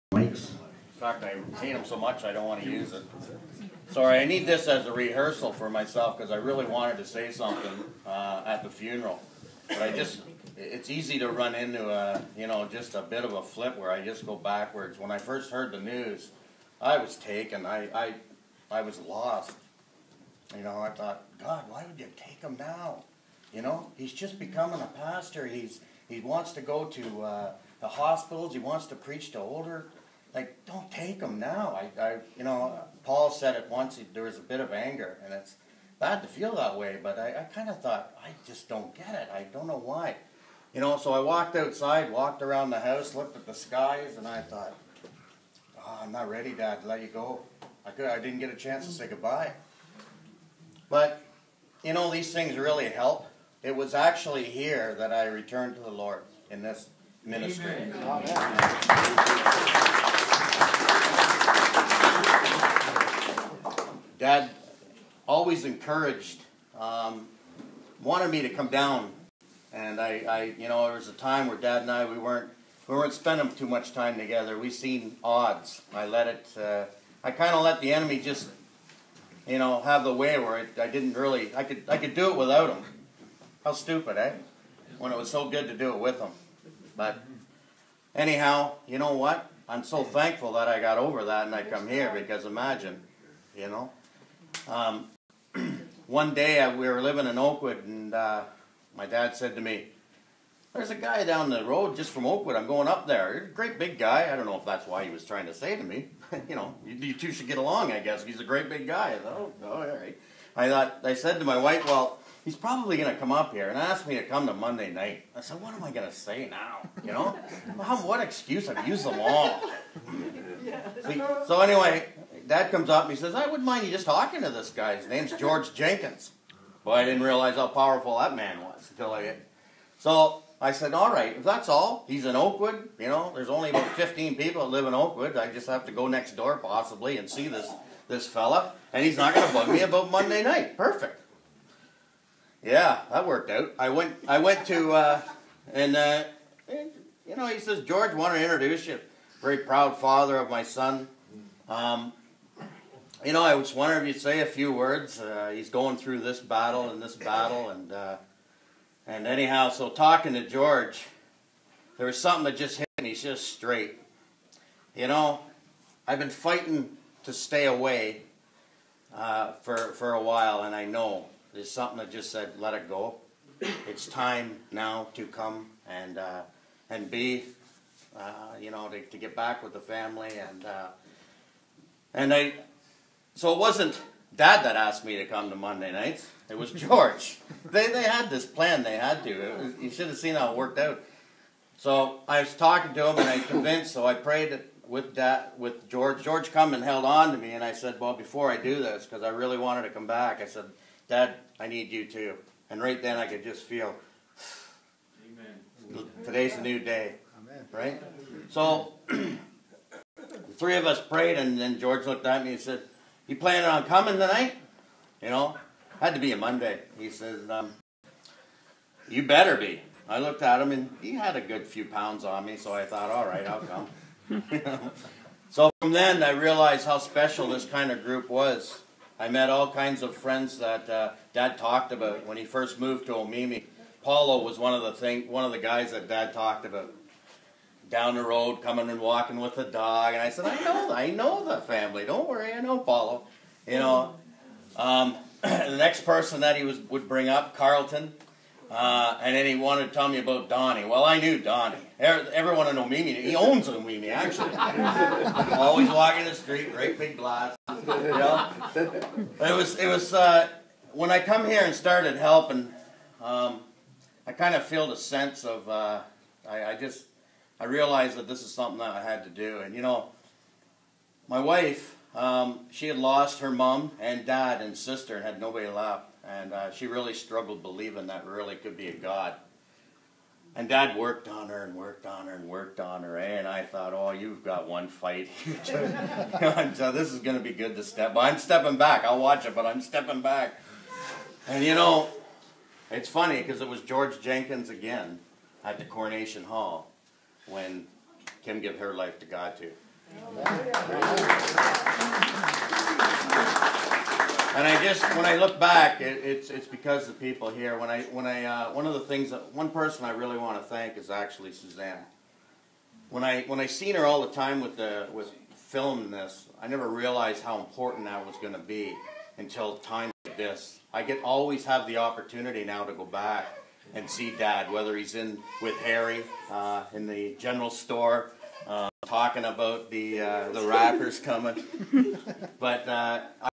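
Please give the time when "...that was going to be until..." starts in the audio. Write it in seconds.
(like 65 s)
318 s.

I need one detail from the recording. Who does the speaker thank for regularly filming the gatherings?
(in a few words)
Suzanne.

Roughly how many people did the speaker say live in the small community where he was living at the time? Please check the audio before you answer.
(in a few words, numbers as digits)
15.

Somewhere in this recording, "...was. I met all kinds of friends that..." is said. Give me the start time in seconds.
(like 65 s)
228 s.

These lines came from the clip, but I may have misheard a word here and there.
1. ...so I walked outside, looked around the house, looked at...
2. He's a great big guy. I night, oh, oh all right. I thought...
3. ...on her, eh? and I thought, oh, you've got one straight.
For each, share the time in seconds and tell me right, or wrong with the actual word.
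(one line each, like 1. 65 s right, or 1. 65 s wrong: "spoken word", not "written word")
1. 40 s wrong: "walked", not "looked"
2. 108 s wrong: "thought", not "night"
3. 282 s wrong: "fight", not "straight".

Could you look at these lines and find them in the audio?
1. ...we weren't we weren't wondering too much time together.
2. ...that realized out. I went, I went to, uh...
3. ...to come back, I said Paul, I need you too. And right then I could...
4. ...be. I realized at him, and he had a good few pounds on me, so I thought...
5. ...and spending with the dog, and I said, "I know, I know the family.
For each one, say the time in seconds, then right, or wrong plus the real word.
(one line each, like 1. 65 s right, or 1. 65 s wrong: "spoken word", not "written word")
1. 72 s wrong: "spending", not "wondering"
2. 143 s wrong: "worked", not "realized"
3. 199 s wrong: "Dad", not "Paul"
4. 219 s wrong: "looked", not "realized"
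5. 238 s wrong: "walking", not "spending".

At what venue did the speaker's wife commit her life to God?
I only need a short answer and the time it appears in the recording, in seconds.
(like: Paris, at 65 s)
Coronation Hall, at 295 s.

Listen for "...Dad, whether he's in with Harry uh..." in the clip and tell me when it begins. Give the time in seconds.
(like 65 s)
324 s.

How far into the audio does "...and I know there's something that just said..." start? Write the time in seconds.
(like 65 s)
170 s.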